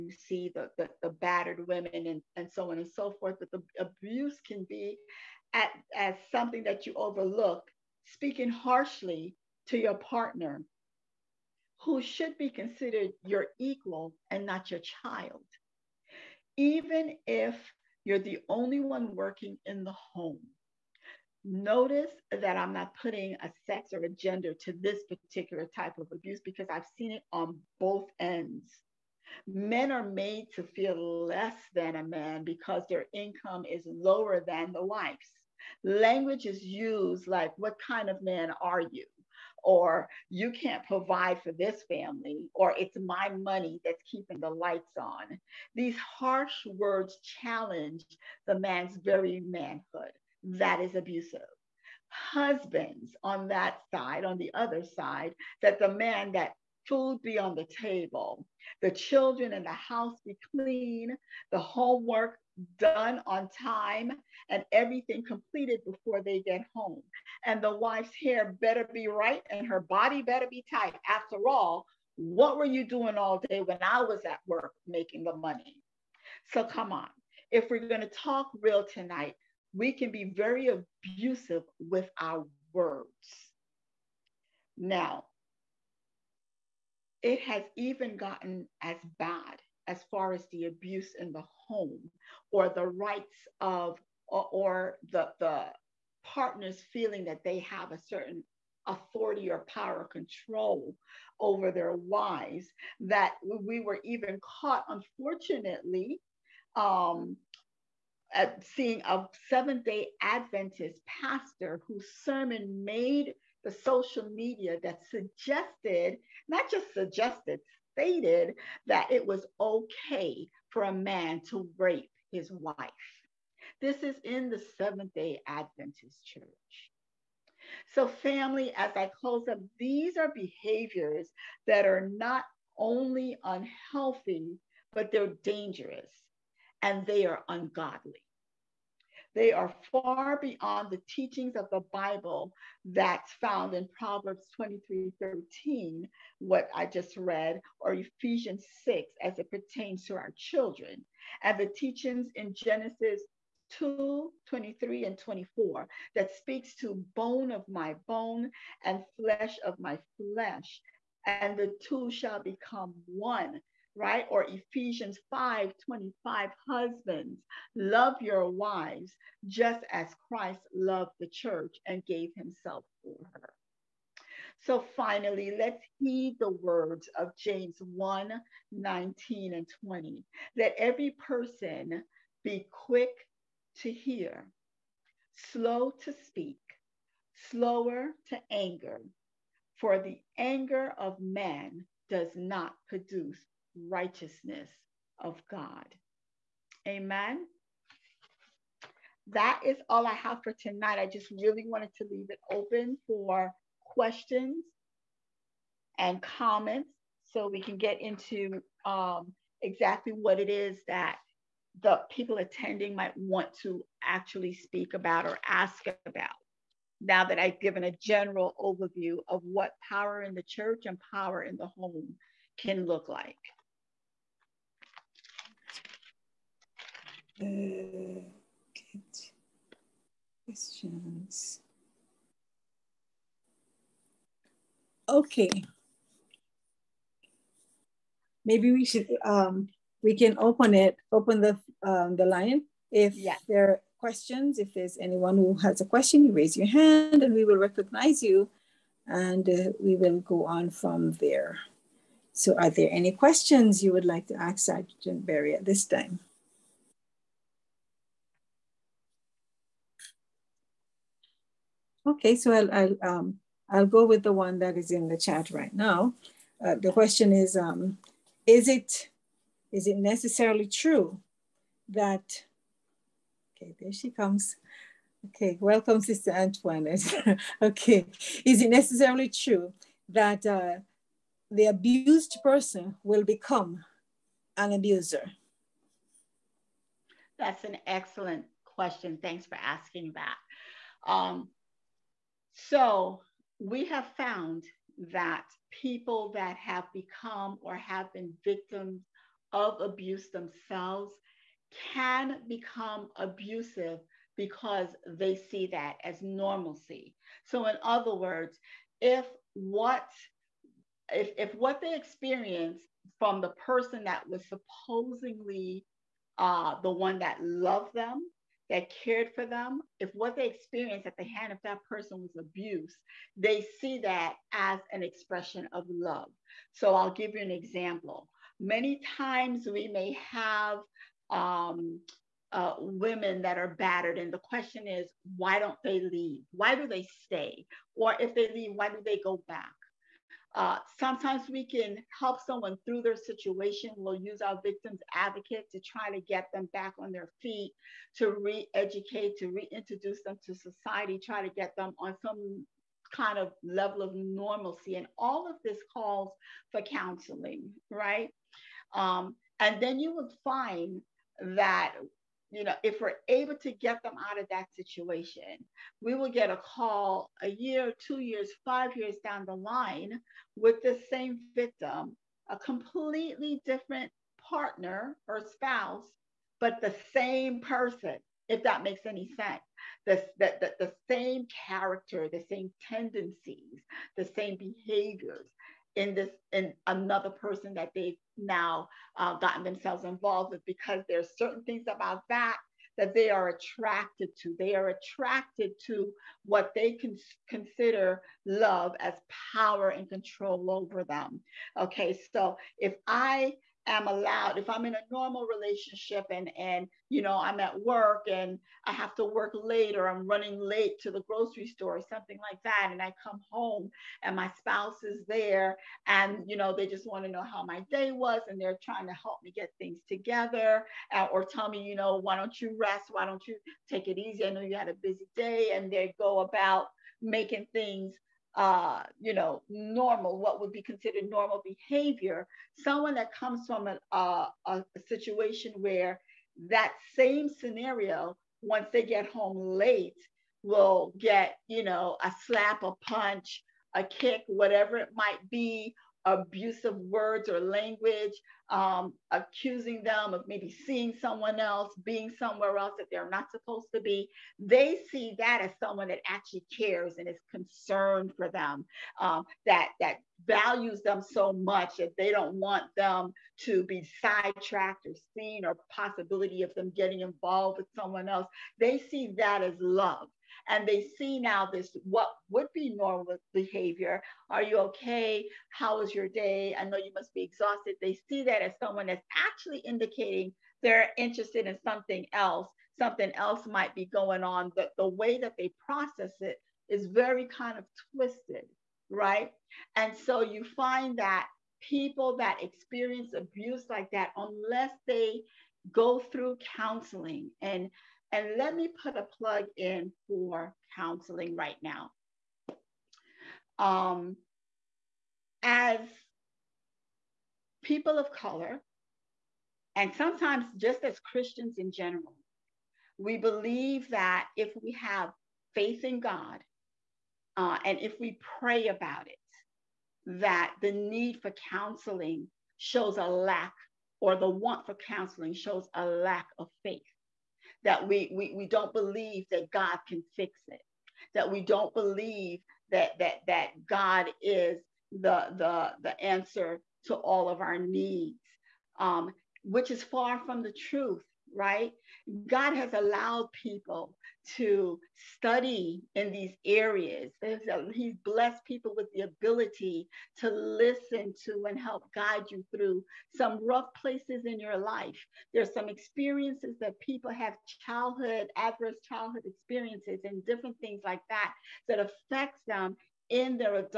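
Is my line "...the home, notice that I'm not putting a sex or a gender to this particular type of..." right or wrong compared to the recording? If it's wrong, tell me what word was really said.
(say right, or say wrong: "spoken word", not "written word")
right.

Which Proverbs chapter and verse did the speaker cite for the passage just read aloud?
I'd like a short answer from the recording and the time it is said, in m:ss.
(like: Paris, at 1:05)
Proverbs 23:13, at 2:23.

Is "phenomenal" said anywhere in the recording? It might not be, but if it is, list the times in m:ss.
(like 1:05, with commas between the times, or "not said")
not said.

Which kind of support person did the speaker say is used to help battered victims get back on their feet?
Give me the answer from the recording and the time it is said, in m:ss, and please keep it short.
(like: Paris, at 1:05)
victims advocate, at 5:44.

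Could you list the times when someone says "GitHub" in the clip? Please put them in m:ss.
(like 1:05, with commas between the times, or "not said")
not said.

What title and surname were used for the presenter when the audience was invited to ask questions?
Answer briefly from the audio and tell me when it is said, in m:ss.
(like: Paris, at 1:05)
Sergeant Berry, at 4:14.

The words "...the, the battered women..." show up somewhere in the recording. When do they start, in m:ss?
0:00.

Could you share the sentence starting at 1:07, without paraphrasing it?
And the wife's hair better be right and her body better be tight.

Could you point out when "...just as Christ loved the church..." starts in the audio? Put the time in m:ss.
2:49.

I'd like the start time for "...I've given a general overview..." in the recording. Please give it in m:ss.
3:37.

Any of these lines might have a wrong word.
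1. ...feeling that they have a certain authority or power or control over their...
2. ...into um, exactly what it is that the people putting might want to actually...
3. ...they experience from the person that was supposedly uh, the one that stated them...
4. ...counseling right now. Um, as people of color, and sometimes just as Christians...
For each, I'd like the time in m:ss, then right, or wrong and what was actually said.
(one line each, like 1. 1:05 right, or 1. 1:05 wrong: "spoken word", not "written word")
1. 1:36 right
2. 3:28 wrong: "attending", not "putting"
3. 5:11 wrong: "loved", not "stated"
4. 8:20 right.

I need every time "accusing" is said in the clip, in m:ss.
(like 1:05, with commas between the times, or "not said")
7:29.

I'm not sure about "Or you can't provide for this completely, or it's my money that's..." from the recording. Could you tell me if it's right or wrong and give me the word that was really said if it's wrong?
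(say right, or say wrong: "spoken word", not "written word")
wrong: "family", not "completely".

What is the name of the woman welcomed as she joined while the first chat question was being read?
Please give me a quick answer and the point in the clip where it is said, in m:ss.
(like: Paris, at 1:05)
Sister Antoinette, at 4:36.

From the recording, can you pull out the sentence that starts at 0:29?
Men are made to feel less than a man because their income is lower than the wife's.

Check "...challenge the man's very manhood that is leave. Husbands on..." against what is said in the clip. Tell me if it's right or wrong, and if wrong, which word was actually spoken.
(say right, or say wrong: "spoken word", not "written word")
wrong: "abusive", not "leave".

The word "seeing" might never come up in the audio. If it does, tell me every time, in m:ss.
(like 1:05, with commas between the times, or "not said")
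1:48, 7:30.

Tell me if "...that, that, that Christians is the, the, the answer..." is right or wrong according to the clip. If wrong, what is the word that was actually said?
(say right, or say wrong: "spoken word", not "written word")
wrong: "God", not "Christians".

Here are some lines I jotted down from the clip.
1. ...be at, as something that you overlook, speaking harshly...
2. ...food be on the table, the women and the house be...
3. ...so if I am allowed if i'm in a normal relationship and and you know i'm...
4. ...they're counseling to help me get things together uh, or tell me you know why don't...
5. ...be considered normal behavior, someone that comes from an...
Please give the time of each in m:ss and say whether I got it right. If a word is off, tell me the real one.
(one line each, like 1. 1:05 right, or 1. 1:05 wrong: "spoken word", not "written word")
1. 0:04 right
2. 0:56 wrong: "children", not "women"
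3. 6:42 right
4. 6:58 wrong: "trying", not "counseling"
5. 7:10 right.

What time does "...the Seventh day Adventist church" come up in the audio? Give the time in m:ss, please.
2:04.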